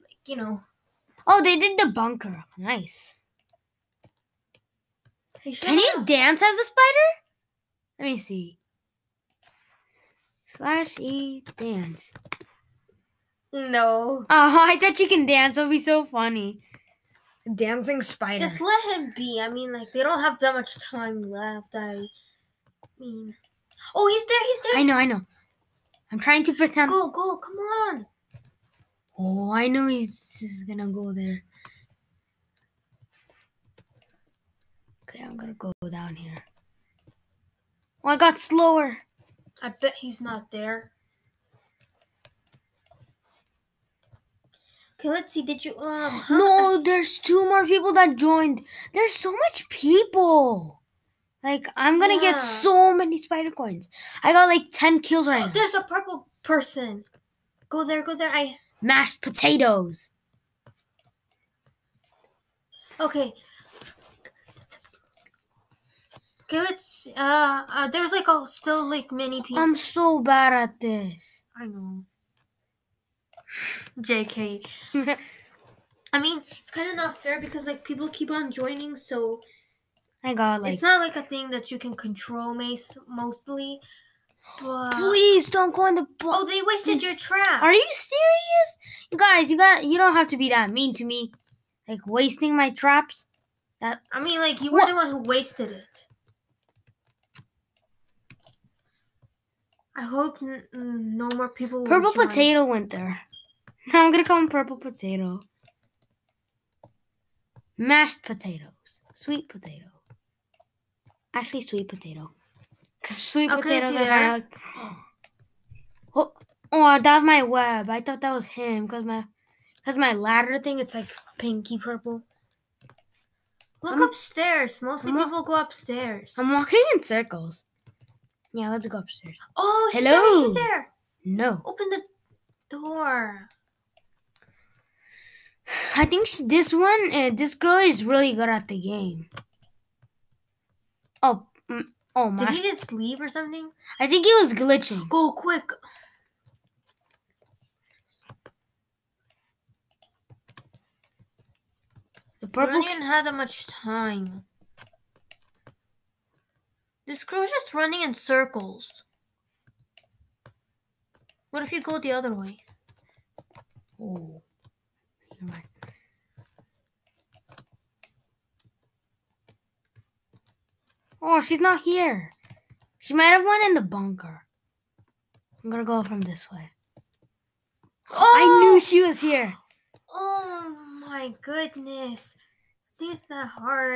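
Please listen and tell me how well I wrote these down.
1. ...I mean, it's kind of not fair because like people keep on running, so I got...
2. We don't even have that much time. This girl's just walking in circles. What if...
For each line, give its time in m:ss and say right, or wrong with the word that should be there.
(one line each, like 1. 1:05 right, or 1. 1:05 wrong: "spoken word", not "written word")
1. 1:16 wrong: "joining", not "running"
2. 2:32 wrong: "running", not "walking".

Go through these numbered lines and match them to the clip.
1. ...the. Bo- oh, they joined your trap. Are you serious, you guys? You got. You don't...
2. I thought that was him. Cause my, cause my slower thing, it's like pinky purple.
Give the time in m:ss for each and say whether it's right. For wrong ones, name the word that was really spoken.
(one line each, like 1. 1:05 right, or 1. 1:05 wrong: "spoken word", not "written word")
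1. 1:25 wrong: "wasted", not "joined"
2. 1:57 wrong: "ladder", not "slower".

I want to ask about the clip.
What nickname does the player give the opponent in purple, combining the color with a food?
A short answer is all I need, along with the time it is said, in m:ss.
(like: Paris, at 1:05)
purple potato, at 1:44.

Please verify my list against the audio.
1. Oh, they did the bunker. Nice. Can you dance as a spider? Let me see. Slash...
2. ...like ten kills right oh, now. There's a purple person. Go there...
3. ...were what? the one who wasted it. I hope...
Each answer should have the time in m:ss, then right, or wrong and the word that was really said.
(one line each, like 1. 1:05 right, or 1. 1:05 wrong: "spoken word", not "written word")
1. 0:01 right
2. 0:54 right
3. 1:34 right.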